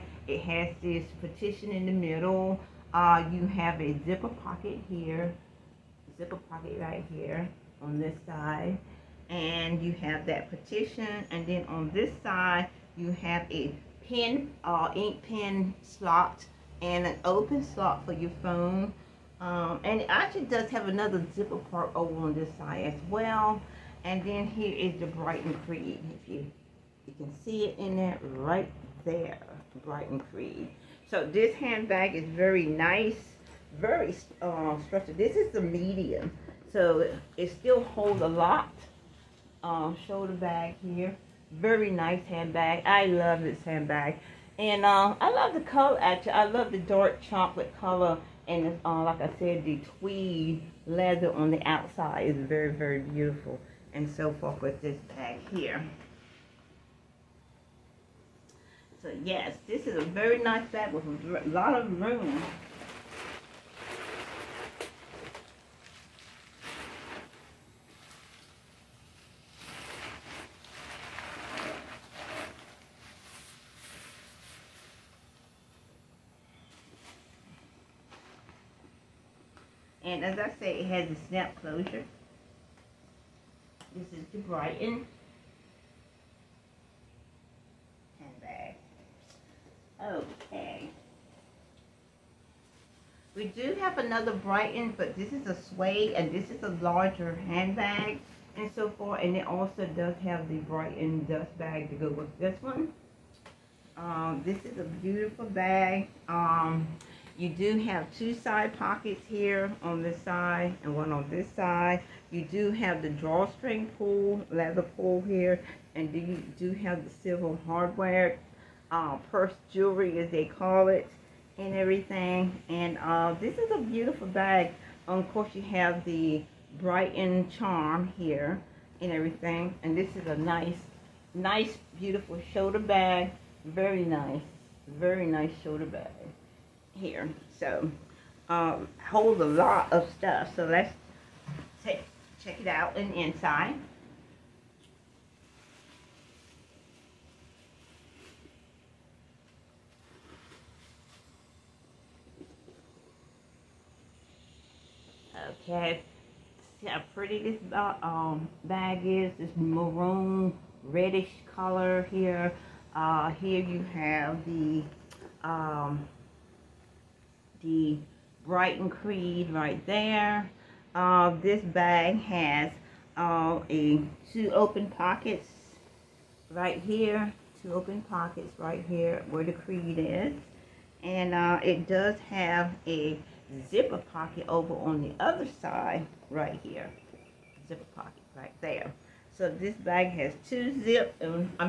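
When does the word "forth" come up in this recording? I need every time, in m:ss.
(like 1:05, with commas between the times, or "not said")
0:54, 1:38.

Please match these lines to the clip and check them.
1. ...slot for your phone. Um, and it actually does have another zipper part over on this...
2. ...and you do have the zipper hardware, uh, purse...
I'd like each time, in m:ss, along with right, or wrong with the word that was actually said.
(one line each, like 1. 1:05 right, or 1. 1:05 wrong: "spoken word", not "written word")
1. 0:17 right
2. 1:55 wrong: "silver", not "zipper".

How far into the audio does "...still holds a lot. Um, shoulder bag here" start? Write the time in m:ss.
0:37.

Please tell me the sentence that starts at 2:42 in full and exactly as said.
Uh, here you have the um, the Brighton Creed right there.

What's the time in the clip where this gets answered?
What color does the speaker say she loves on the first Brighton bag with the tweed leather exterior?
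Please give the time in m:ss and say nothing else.
0:46.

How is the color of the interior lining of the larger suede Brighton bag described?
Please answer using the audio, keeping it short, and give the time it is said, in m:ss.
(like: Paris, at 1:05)
Maroon reddish, at 2:39.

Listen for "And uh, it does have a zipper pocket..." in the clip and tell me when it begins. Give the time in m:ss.
3:01.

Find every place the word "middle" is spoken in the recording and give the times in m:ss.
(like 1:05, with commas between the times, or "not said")
0:01.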